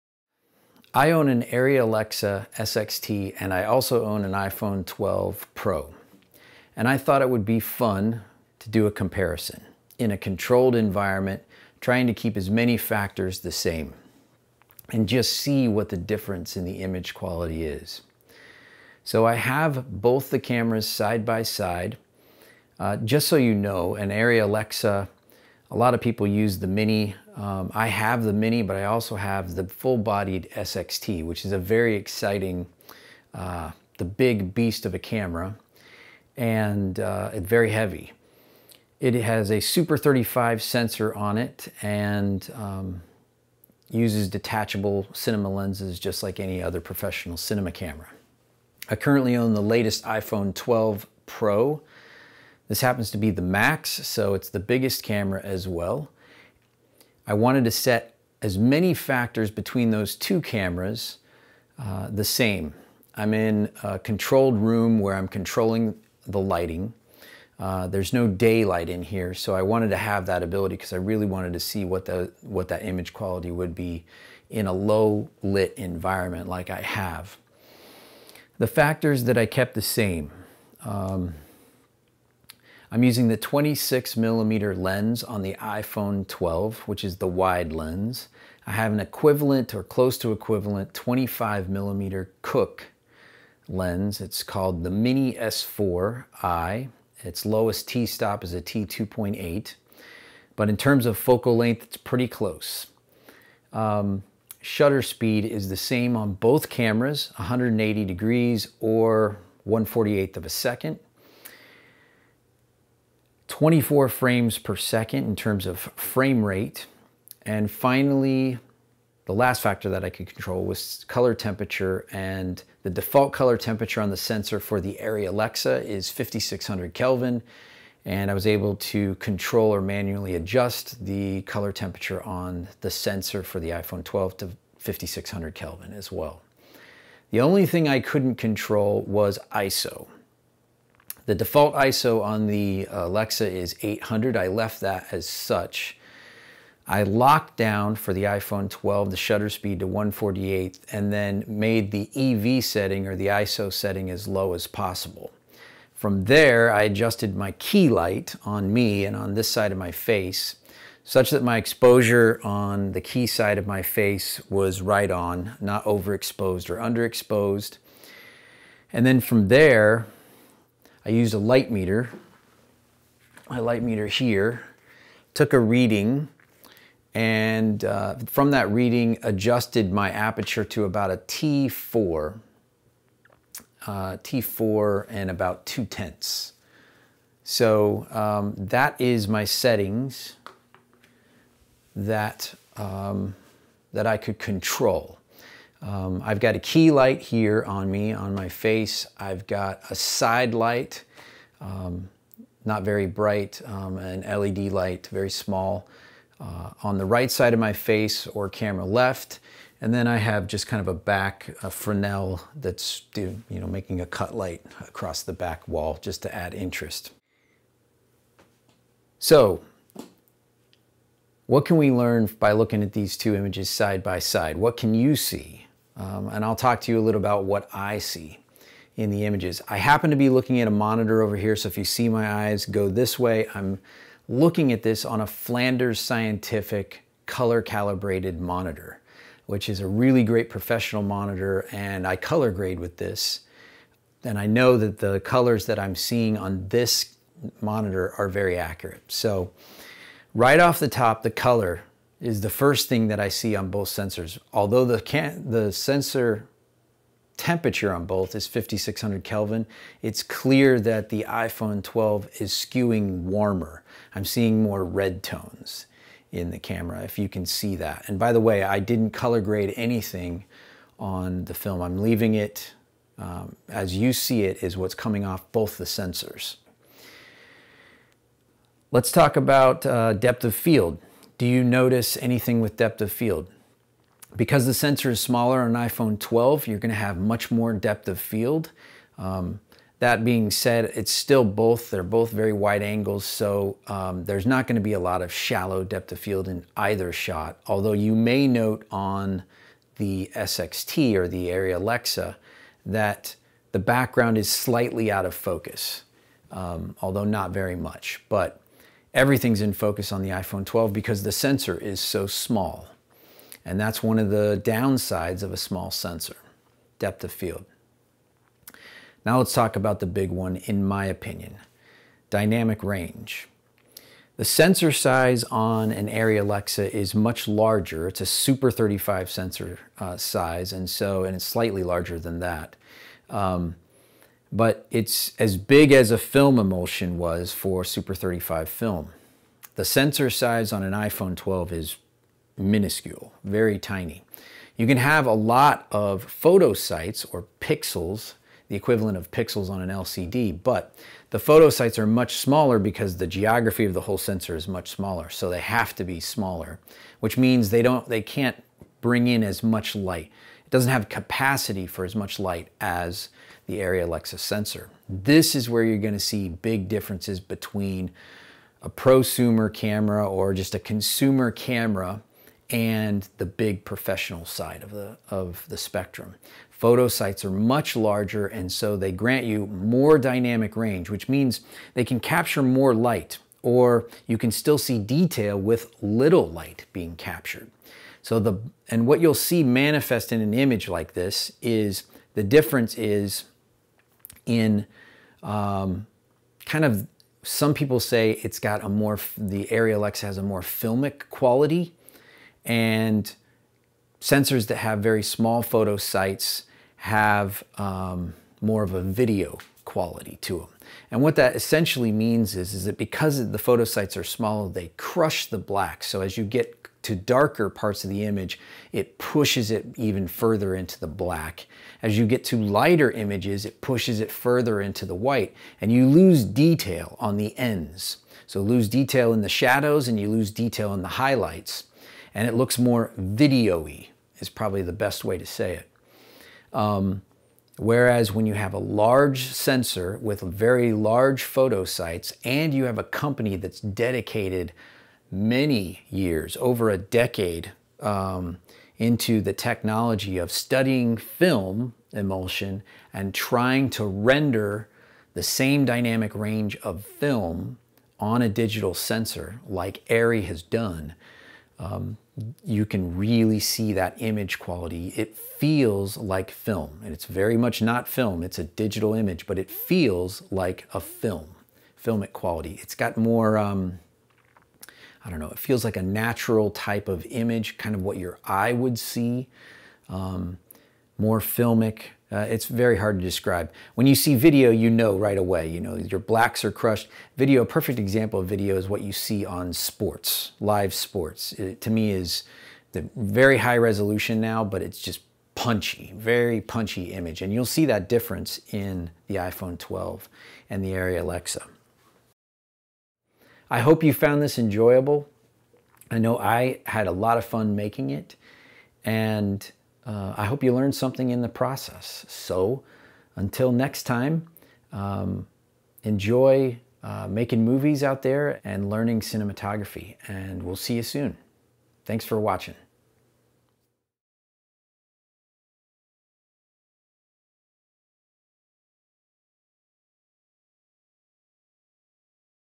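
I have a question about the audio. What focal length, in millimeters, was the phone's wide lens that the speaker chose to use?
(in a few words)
26.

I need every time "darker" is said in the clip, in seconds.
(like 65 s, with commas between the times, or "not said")
417 s.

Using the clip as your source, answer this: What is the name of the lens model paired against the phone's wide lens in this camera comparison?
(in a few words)
Mini S4i.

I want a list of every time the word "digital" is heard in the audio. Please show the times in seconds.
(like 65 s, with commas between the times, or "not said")
458 s, 468 s.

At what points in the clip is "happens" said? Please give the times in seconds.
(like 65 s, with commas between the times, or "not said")
52 s, 229 s.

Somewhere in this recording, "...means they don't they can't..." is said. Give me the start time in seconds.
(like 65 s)
357 s.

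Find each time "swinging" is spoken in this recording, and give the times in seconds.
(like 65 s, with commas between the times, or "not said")
not said.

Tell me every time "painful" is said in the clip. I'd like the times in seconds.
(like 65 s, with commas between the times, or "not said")
not said.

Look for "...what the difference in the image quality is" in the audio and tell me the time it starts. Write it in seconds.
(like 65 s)
15 s.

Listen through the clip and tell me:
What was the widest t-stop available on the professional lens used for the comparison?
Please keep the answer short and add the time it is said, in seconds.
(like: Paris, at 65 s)
T2.8, at 98 s.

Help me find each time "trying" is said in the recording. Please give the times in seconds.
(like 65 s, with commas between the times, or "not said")
11 s, 453 s.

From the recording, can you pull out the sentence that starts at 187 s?
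So um, that is my settings that, um, that I could control.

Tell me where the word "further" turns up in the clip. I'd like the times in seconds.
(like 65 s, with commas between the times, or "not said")
420 s, 424 s.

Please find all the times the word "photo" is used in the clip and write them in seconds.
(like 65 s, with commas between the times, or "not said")
346 s, 351 s, 376 s, 405 s, 413 s, 441 s.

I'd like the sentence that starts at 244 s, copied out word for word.
And I know that the colors that I'm seeing on this monitor are very accurate.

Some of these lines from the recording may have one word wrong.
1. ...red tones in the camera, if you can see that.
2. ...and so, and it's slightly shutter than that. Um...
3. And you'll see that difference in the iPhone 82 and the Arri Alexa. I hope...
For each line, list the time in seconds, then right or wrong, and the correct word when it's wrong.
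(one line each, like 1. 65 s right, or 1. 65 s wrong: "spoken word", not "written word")
1. 264 s right
2. 330 s wrong: "larger", not "shutter"
3. 497 s wrong: "12", not "82".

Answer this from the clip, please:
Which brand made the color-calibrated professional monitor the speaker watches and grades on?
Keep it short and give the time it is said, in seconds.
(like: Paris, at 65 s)
Flanders Scientific, at 235 s.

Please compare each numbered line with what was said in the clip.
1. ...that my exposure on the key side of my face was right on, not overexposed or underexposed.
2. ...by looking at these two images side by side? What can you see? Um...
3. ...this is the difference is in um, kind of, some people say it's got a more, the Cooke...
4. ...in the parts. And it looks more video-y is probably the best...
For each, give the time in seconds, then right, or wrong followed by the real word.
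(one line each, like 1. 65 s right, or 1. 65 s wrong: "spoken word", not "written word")
1. 161 s right
2. 222 s right
3. 391 s wrong: "Arri", not "Cooke"
4. 430 s wrong: "highlights", not "parts".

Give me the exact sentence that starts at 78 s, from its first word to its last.
The factors that I kept the same.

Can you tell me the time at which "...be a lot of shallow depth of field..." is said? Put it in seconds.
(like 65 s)
294 s.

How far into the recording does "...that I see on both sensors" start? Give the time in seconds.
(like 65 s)
253 s.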